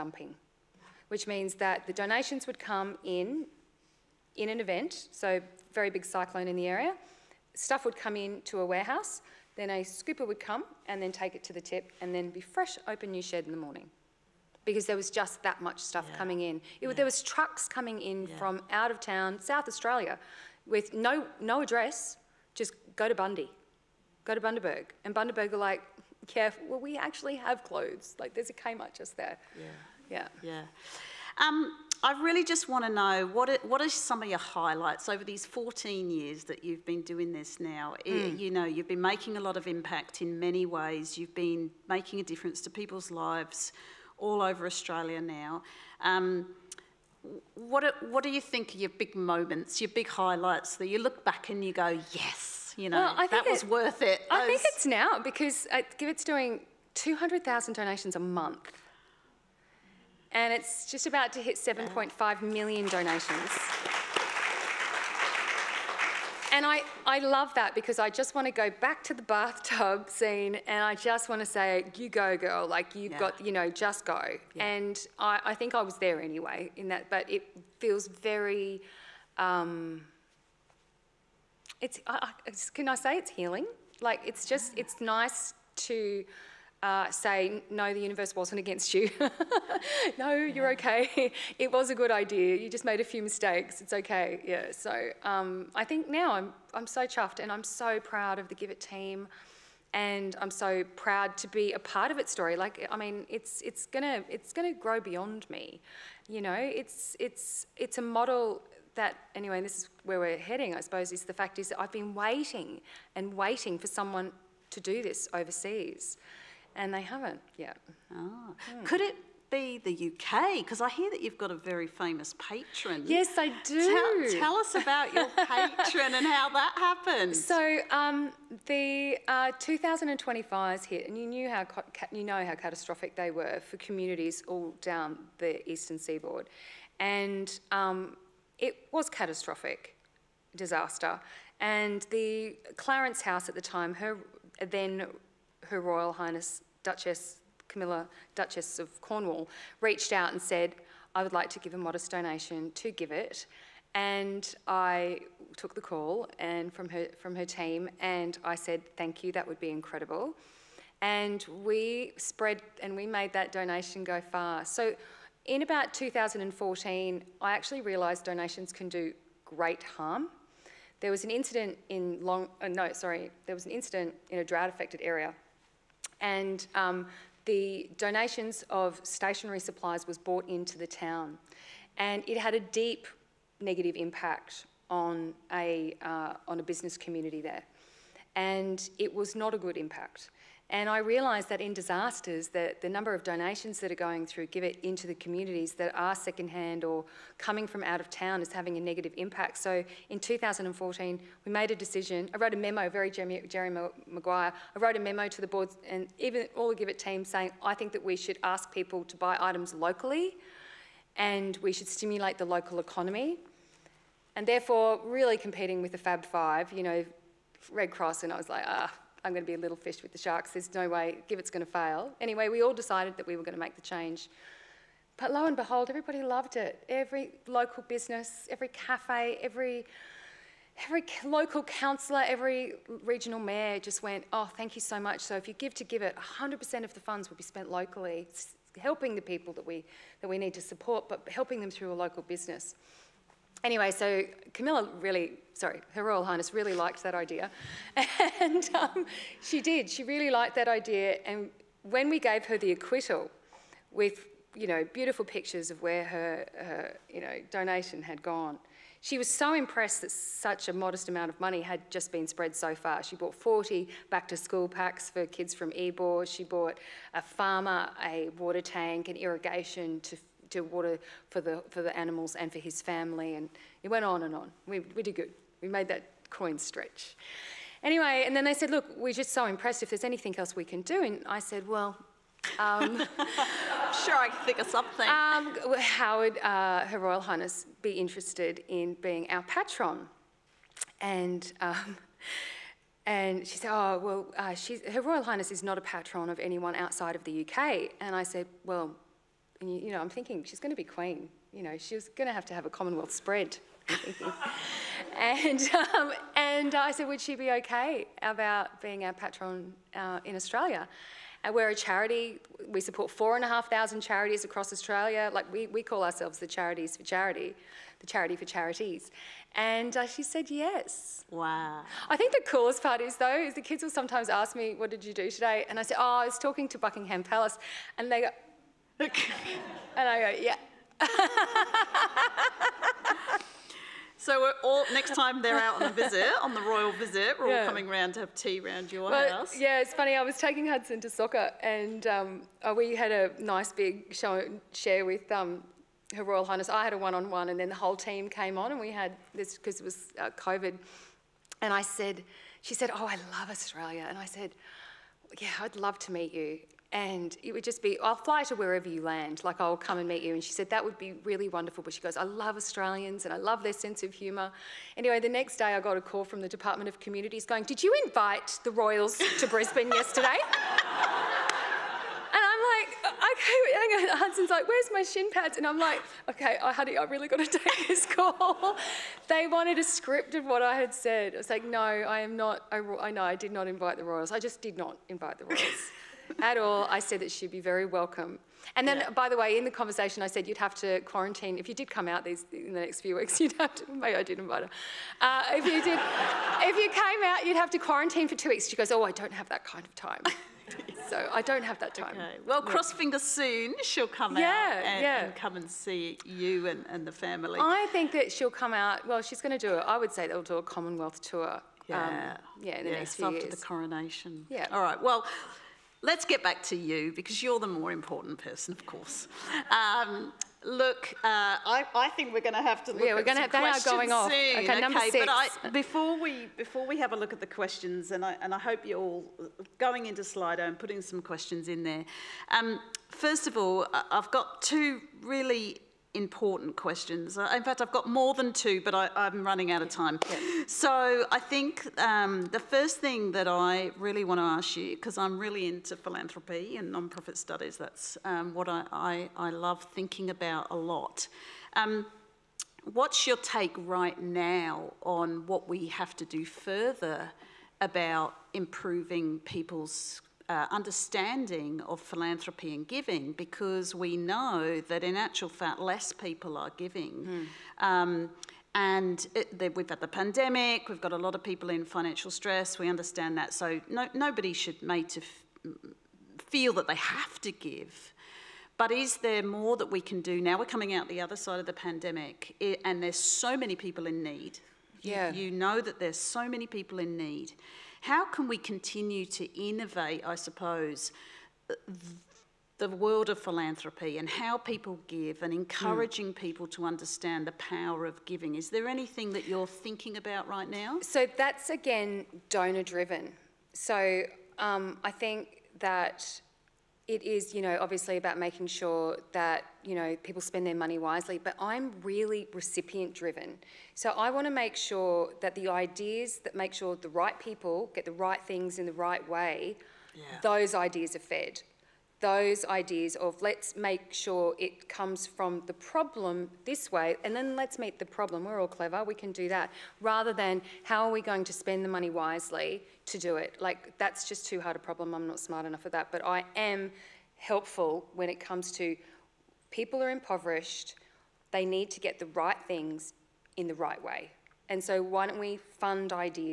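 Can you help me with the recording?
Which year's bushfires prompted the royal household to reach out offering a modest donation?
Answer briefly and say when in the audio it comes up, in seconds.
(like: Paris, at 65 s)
2020, at 129 s.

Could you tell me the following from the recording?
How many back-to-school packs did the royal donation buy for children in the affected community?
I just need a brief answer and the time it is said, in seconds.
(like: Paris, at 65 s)
40, at 263 s.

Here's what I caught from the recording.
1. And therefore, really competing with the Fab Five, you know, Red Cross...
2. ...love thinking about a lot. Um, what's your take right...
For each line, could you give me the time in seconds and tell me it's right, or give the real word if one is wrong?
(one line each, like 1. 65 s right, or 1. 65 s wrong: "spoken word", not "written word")
1. 214 s right
2. 449 s right.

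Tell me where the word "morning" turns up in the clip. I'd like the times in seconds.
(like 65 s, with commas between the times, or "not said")
13 s.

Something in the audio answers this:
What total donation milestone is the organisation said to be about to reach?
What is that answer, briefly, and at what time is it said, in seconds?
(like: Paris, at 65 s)
7.5 million, at 61 s.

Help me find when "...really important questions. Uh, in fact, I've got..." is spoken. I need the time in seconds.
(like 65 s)
435 s.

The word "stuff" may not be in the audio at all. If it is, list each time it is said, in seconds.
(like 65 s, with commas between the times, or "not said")
7 s, 15 s.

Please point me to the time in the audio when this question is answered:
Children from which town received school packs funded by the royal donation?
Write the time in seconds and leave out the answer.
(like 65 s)
265 s.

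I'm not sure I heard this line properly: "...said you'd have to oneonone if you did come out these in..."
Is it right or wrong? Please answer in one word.
wrong.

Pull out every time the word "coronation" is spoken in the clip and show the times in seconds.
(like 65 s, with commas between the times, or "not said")
413 s.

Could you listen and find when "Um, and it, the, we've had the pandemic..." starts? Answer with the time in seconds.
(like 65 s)
467 s.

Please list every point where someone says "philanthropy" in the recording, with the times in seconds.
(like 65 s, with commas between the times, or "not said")
445 s, 462 s, 493 s.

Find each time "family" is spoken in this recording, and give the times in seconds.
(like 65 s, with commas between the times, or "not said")
272 s, 407 s.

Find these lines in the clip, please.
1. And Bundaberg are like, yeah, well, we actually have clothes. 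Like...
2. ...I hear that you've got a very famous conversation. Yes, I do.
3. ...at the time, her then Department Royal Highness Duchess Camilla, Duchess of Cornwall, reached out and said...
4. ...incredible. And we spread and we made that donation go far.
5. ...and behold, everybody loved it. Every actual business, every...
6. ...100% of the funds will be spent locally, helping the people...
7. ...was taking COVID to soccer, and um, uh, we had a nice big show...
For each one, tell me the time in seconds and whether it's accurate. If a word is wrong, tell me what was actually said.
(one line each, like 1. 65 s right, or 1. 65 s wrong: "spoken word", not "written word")
1. 25 s right
2. 120 s wrong: "patron", not "conversation"
3. 143 s wrong: "Her", not "Department"
4. 159 s right
5. 225 s wrong: "local", not "actual"
6. 236 s right
7. 340 s wrong: "Hudson", not "COVID".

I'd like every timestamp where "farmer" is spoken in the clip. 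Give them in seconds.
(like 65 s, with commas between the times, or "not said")
267 s.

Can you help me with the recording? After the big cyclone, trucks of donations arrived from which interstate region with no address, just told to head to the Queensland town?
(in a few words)
South Australia.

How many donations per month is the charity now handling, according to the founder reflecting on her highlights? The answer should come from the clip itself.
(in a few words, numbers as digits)
200,000.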